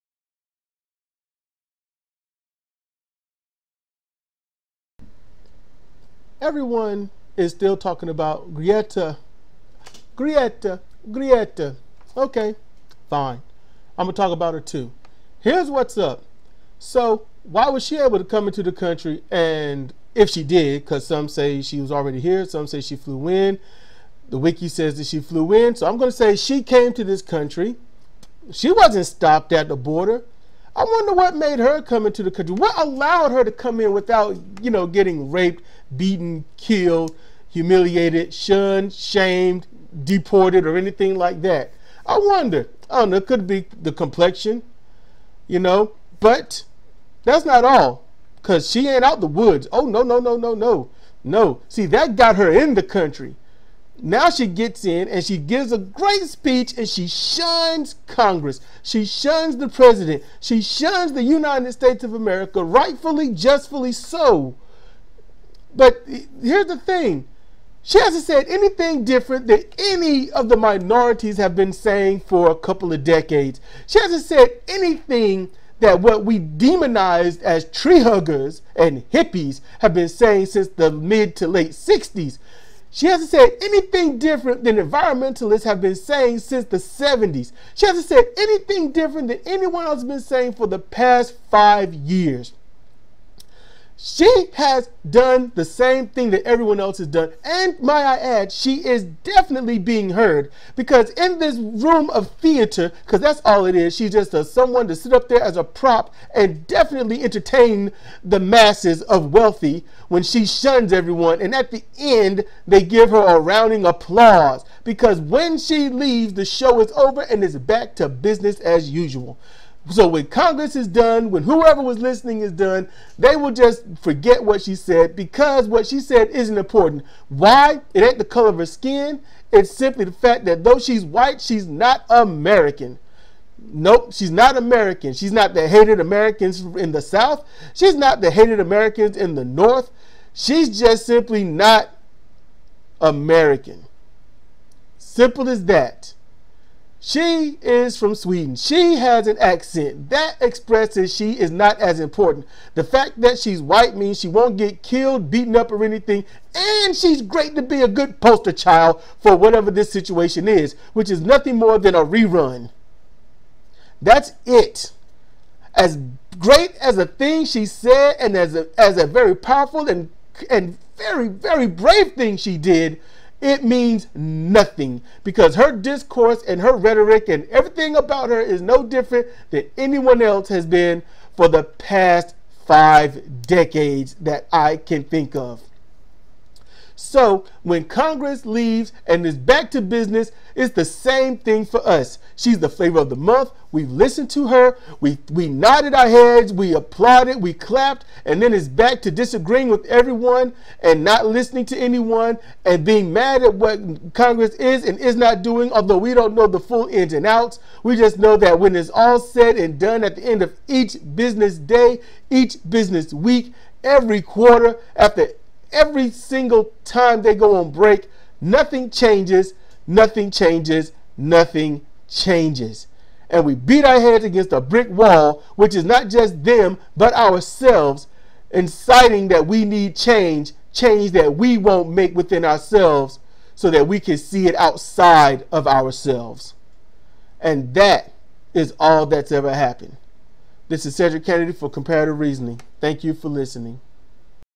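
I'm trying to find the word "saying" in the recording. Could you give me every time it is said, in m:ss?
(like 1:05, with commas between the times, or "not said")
1:11, 1:20, 1:25, 1:30.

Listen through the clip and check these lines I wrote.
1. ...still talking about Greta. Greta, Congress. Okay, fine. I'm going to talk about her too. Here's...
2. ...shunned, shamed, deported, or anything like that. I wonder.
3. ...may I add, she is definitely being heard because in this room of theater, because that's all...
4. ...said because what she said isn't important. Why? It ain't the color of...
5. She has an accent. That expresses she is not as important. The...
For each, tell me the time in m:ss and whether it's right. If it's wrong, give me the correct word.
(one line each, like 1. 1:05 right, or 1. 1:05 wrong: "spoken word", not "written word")
1. 0:07 wrong: "Greta", not "Congress"
2. 0:38 right
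3. 1:37 right
4. 2:04 right
5. 2:28 right.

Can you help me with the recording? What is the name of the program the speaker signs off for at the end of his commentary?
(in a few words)
Comparative Reasoning.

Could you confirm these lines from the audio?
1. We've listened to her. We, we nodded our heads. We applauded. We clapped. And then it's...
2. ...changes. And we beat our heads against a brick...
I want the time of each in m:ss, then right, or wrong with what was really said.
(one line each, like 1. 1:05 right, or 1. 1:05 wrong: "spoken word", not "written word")
1. 3:13 right
2. 3:42 right.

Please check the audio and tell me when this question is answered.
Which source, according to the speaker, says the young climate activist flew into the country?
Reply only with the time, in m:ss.
0:24.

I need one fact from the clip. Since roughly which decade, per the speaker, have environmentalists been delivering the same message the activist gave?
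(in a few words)
The 70s.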